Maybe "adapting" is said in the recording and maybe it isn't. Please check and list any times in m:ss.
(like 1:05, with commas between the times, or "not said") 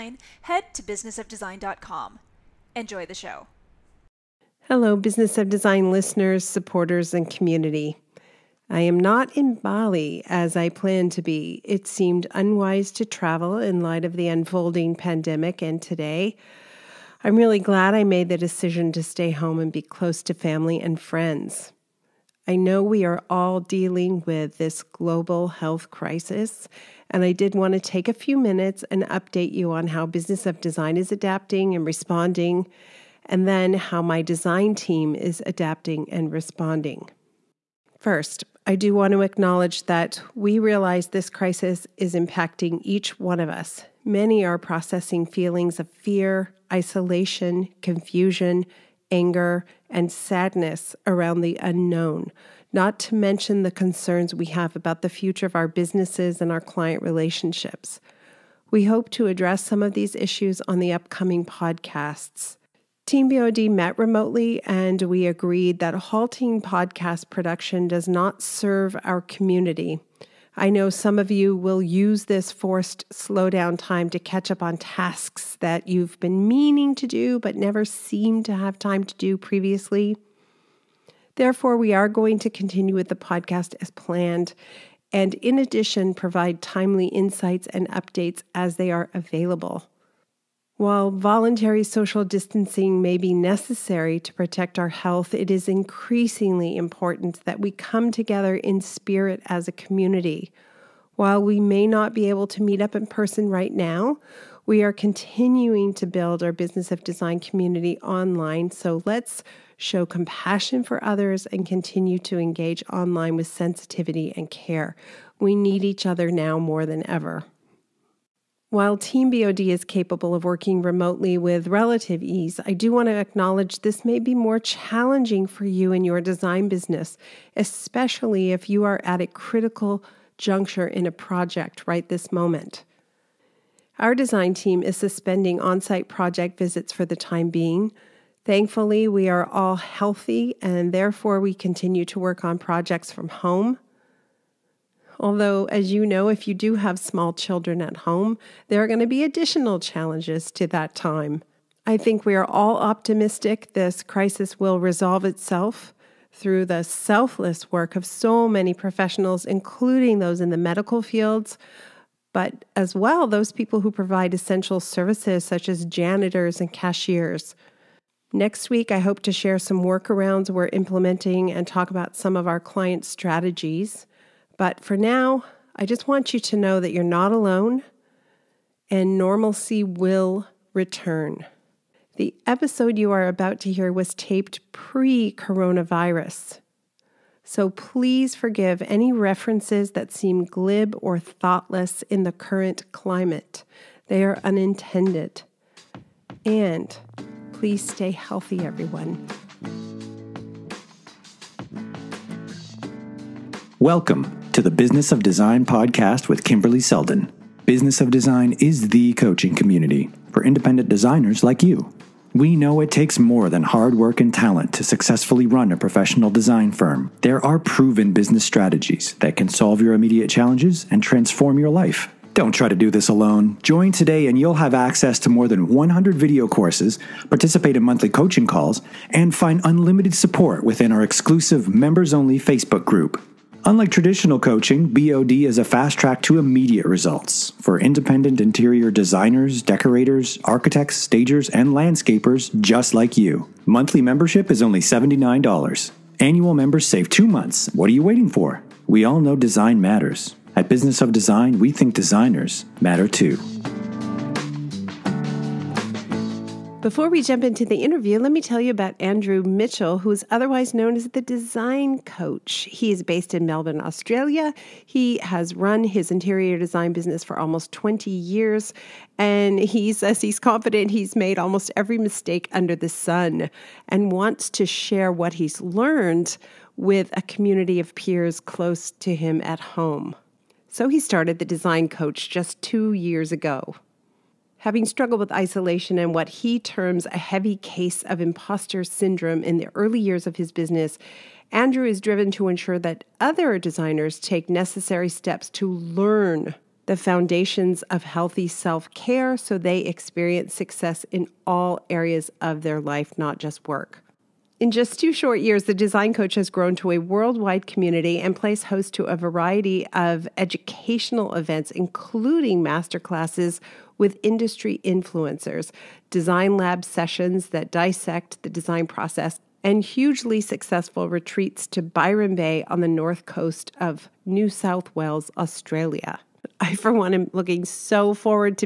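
0:31, 0:35.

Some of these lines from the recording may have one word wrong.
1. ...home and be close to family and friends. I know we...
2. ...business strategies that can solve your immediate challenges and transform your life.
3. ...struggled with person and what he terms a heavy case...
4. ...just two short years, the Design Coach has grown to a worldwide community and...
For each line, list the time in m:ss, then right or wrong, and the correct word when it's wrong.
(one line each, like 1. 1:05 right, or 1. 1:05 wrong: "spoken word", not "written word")
1. 0:19 right
2. 3:38 right
3. 4:44 wrong: "isolation", not "person"
4. 5:04 right.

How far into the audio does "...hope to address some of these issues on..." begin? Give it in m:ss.
0:58.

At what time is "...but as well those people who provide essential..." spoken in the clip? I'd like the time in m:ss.
2:42.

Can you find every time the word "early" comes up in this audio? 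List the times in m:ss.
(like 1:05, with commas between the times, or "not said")
4:49.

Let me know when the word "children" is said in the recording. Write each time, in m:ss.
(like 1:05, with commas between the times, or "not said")
2:27.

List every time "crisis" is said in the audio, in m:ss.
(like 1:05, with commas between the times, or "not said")
0:25, 0:41, 2:34.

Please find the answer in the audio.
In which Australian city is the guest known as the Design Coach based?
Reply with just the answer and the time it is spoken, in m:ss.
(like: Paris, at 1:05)
Melbourne, at 4:23.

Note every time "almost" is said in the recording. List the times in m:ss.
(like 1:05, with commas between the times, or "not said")
4:27, 4:31.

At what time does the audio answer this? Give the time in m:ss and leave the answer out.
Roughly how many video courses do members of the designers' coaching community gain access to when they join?
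3:45.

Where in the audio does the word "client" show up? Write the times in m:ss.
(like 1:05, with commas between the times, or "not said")
0:56, 2:52.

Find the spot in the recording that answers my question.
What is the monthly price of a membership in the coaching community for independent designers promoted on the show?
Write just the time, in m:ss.
4:04.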